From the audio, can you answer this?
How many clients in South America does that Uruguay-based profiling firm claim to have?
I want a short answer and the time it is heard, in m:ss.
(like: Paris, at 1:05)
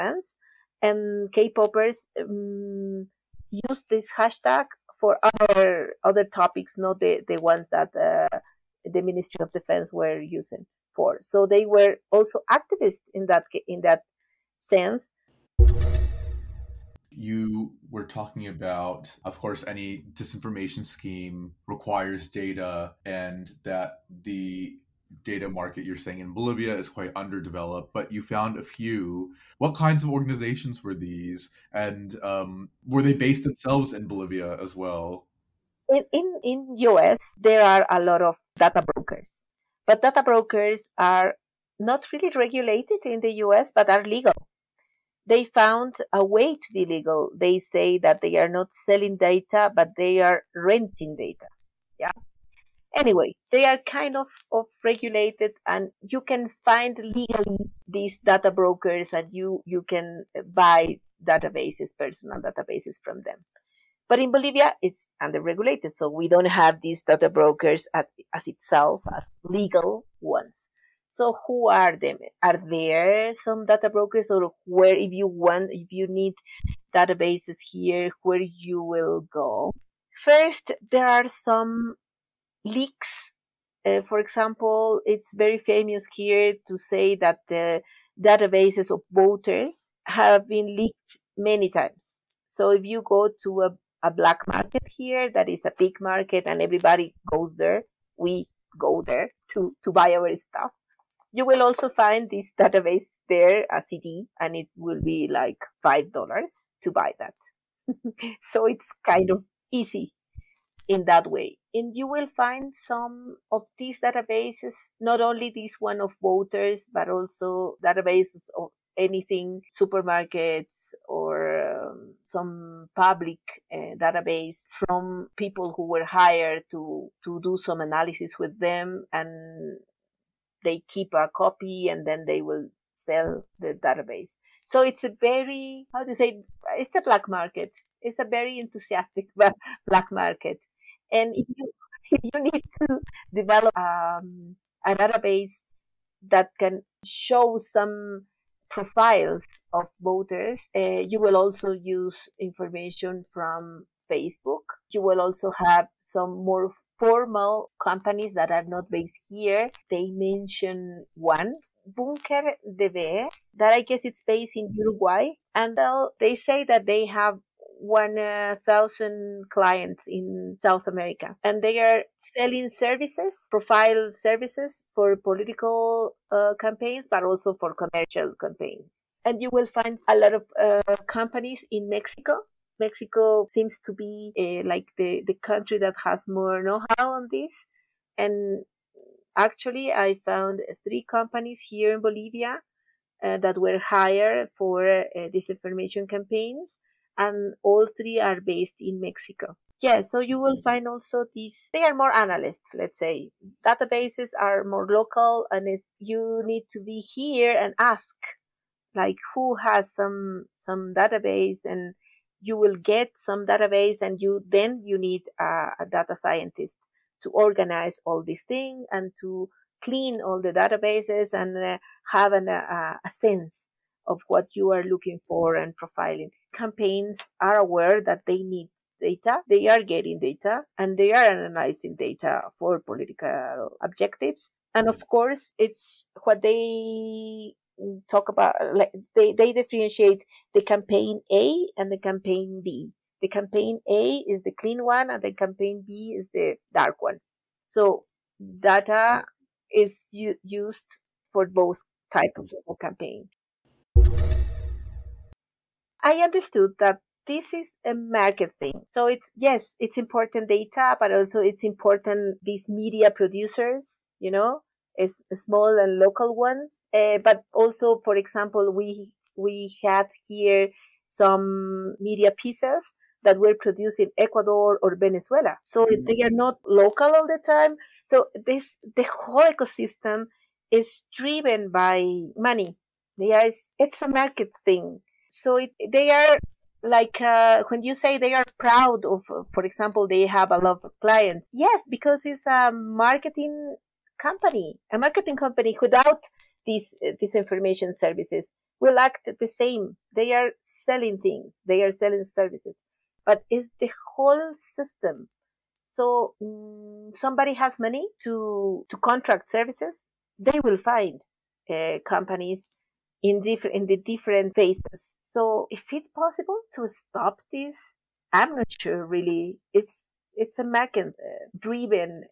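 1,000, at 2:47.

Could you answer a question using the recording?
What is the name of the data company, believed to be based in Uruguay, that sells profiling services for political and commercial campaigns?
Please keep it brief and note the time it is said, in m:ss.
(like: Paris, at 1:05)
Bunker DB, at 2:41.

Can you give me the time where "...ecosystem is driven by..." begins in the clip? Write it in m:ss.
4:39.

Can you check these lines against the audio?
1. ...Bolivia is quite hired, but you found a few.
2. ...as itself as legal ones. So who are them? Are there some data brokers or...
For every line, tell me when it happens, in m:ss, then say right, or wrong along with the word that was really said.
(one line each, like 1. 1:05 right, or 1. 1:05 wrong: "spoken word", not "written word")
1. 0:26 wrong: "underdeveloped", not "hired"
2. 1:08 right.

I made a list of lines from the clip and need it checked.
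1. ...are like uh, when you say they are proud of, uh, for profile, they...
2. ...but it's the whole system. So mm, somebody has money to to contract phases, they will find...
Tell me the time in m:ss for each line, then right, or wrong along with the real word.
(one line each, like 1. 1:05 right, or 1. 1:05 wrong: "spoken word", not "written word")
1. 4:46 wrong: "example", not "profile"
2. 5:03 wrong: "services", not "phases".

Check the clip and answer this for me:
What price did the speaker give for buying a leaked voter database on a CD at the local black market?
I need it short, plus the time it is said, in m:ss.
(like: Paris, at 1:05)
$5, at 1:45.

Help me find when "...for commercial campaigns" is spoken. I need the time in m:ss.
2:57.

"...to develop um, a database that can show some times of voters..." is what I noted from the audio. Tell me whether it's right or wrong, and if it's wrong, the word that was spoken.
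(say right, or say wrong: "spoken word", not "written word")
wrong: "profiles", not "times".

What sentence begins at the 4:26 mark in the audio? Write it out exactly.
Uh, but also, for example, we, we had here some media pieces that were produced in Ecuador or Venezuela.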